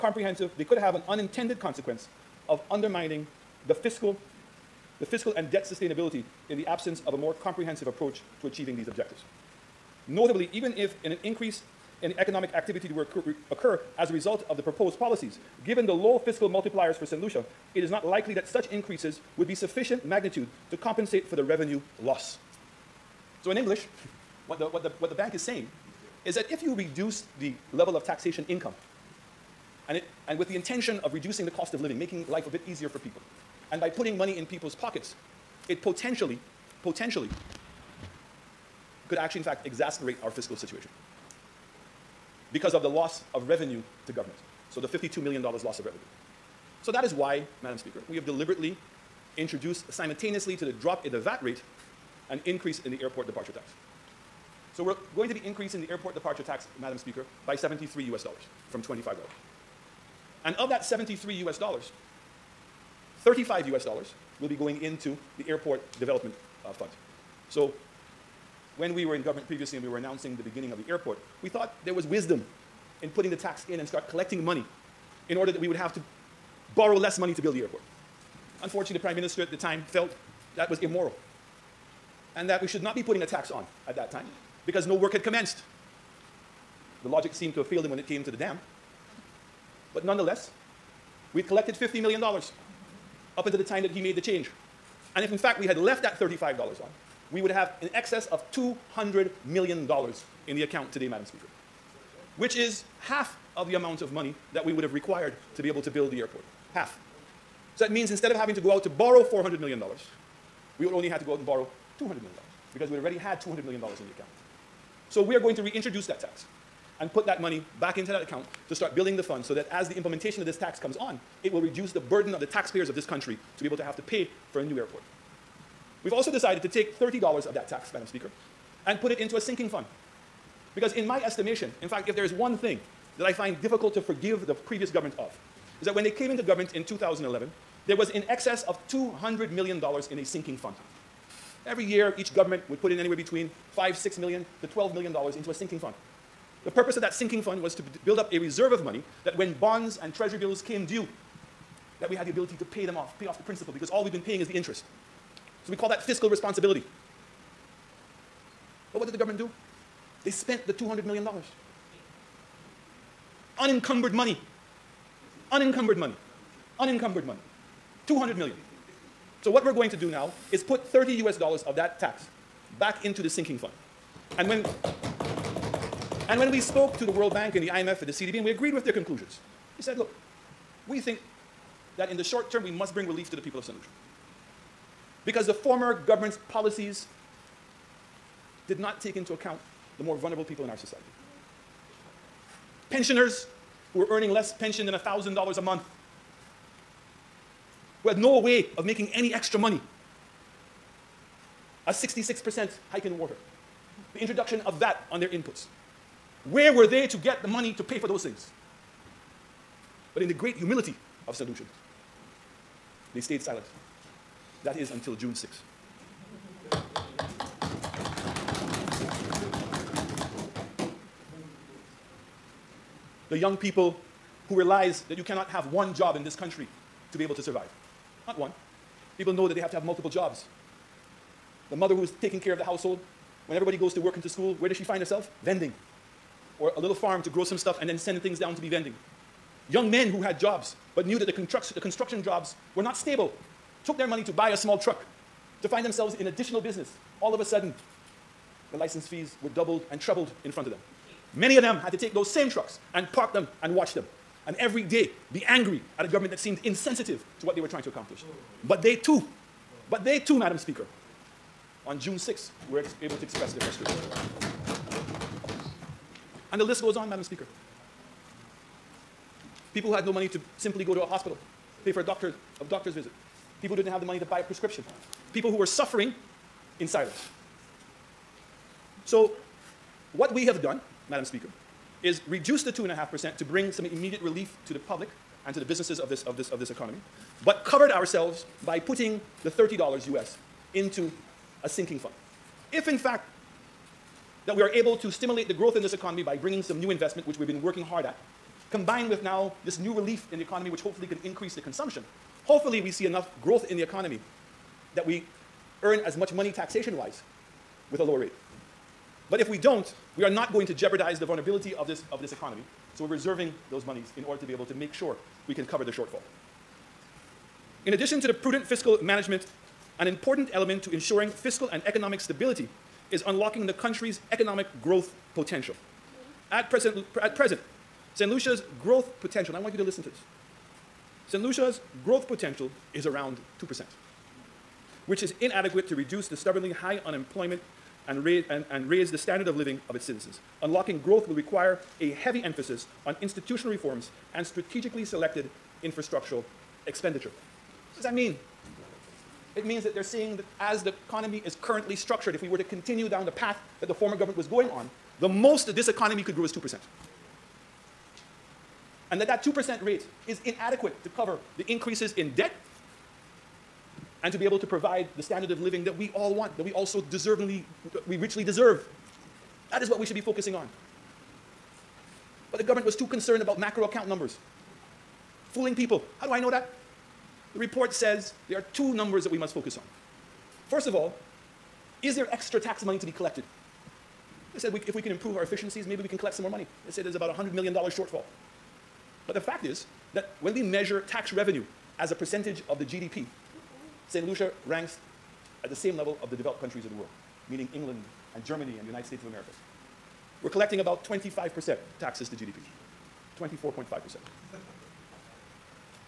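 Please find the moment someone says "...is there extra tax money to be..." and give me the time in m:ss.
6:22.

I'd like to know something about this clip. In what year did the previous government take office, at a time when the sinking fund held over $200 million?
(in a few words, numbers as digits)
2011.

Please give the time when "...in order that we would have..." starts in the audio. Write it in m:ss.
1:15.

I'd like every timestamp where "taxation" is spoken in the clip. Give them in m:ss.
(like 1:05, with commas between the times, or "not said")
0:28, 5:06.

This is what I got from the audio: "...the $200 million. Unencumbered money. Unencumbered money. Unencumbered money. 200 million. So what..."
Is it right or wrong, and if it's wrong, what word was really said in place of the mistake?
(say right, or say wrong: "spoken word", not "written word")
right.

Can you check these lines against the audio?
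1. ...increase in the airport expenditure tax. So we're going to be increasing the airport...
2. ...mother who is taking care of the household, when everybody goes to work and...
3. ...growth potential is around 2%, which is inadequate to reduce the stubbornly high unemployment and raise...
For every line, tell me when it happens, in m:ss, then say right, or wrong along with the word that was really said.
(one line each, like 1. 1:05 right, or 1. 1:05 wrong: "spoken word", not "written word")
1. 0:52 wrong: "departure", not "expenditure"
2. 3:51 right
3. 5:32 right.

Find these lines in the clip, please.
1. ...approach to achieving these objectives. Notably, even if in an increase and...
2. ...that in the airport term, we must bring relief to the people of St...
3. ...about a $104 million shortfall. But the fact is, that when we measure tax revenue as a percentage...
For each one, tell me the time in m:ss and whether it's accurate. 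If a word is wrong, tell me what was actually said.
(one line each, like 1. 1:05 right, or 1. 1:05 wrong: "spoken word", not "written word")
1. 0:07 right
2. 3:01 wrong: "short", not "airport"
3. 6:27 wrong: "100", not "104".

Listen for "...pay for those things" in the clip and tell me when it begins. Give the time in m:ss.
3:27.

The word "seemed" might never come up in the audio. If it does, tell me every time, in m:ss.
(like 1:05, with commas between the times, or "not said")
1:27, 4:16.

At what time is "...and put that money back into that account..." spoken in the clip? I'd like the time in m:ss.
1:56.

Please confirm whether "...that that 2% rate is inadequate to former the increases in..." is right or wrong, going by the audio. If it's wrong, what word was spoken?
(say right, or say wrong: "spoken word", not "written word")
wrong: "cover", not "former".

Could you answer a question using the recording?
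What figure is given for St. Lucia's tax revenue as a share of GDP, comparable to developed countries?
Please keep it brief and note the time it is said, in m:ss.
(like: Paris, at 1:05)
24.5%, at 6:43.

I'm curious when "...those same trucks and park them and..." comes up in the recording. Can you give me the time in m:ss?
4:12.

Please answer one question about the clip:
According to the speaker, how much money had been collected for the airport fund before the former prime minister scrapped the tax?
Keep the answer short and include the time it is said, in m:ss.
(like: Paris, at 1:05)
$50 million, at 1:31.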